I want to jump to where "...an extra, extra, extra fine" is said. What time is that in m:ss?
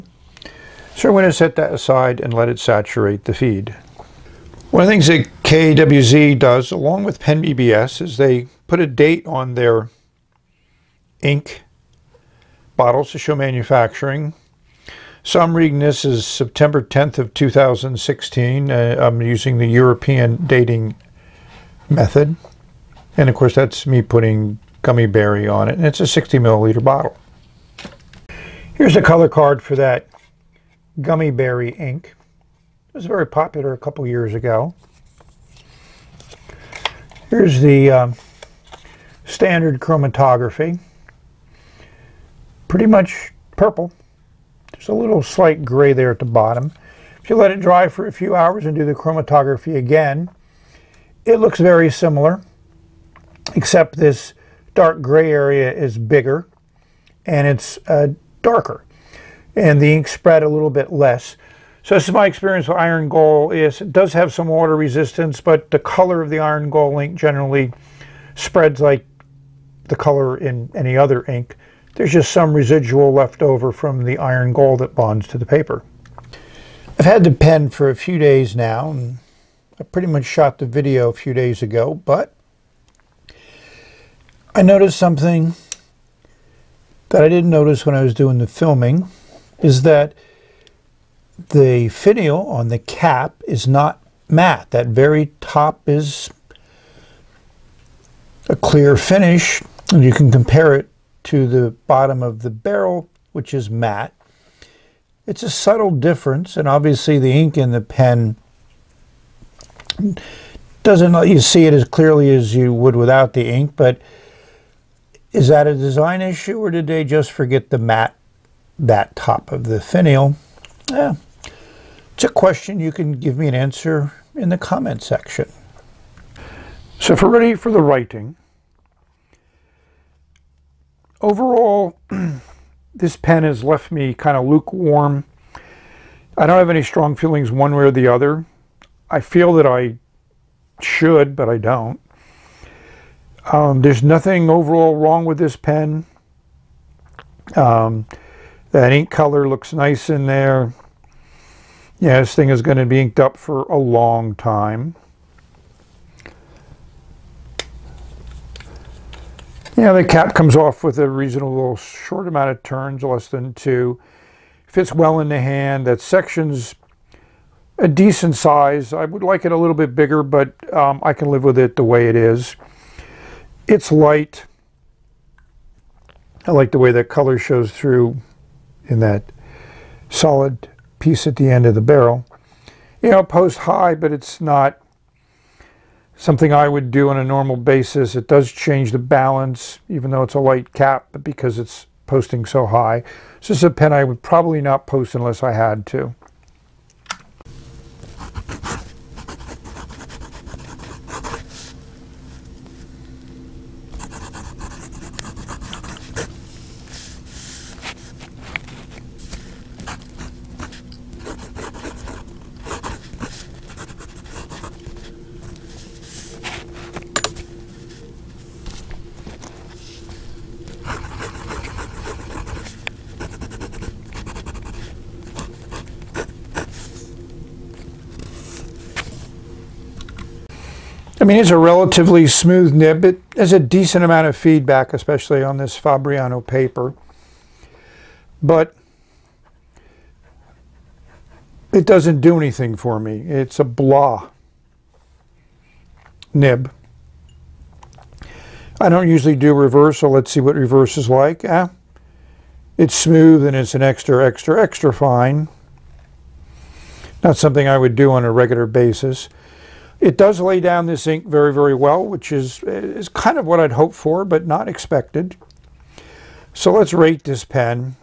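4:13.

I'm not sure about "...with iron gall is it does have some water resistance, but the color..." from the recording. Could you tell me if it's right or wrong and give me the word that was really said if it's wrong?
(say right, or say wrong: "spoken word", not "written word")
right.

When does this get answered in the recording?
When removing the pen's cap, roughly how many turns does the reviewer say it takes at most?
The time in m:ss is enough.
2:43.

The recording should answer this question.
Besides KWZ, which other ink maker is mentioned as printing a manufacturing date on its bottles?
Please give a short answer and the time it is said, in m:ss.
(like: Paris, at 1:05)
PenBBS, at 0:07.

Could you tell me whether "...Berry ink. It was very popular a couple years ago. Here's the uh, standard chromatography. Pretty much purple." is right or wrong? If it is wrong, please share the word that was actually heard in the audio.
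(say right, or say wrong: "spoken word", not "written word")
right.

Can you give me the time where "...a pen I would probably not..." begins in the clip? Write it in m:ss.
3:13.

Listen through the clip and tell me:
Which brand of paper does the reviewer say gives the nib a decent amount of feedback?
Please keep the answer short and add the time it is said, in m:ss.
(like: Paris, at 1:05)
Fabriano, at 3:55.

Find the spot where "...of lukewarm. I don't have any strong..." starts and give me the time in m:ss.
2:14.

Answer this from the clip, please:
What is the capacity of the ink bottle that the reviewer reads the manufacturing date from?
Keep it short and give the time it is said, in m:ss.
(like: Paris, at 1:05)
60 milliliters, at 0:26.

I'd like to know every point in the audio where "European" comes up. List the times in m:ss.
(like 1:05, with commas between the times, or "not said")
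0:19.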